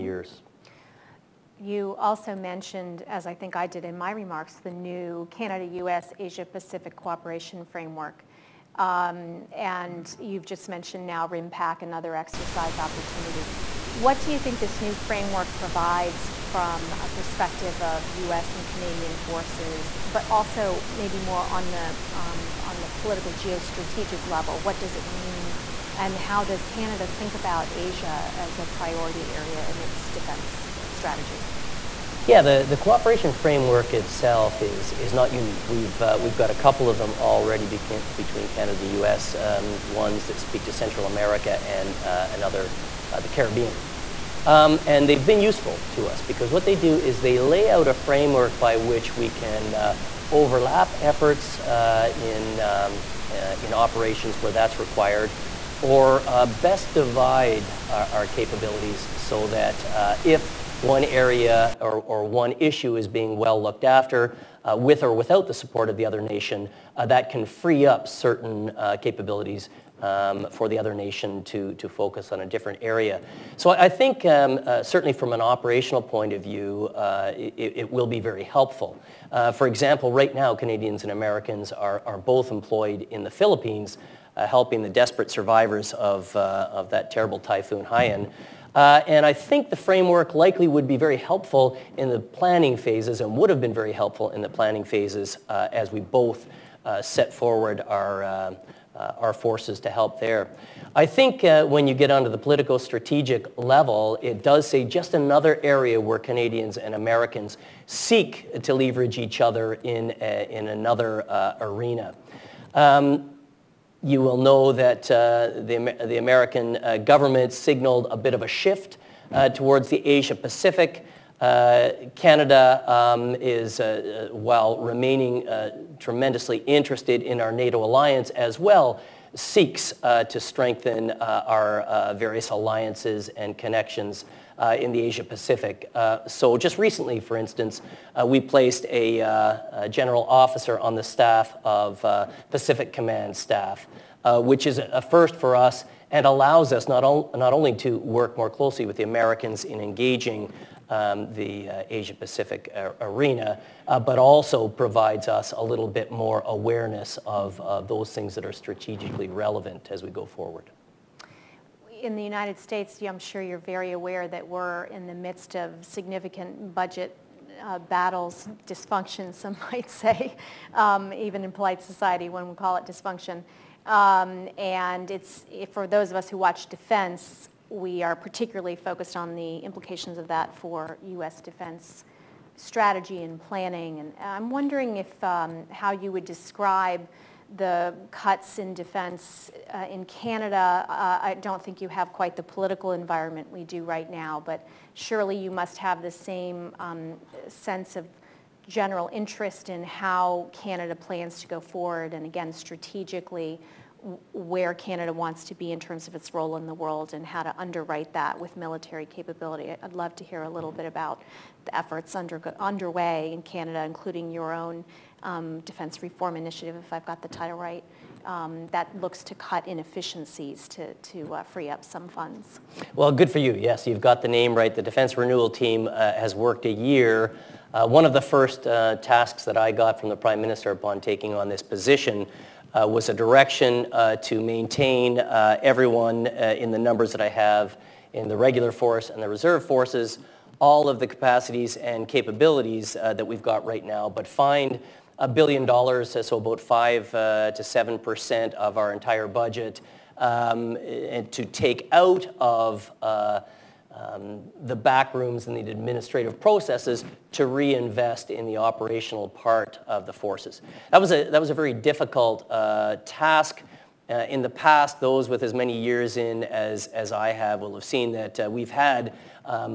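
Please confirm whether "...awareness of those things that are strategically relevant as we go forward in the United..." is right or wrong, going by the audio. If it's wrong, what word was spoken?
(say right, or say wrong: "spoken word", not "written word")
right.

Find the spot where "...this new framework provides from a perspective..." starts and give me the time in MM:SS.
00:14.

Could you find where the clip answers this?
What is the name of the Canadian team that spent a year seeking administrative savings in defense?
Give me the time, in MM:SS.
03:44.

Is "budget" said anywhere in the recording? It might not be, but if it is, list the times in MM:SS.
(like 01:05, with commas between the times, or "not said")
02:46, 04:09.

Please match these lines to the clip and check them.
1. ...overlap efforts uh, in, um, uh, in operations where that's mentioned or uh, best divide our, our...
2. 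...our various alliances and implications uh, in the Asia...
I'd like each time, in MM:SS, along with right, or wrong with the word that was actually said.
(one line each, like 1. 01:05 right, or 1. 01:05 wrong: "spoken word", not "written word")
1. 00:50 wrong: "required", not "mentioned"
2. 02:11 wrong: "connections", not "implications".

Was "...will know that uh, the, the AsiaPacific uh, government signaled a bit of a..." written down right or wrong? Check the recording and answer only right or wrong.
wrong.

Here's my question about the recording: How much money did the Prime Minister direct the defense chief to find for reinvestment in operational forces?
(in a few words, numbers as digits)
a billion dollars.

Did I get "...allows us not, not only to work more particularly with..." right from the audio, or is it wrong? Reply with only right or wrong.
wrong.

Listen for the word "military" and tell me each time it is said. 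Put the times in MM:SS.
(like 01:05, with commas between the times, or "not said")
03:28.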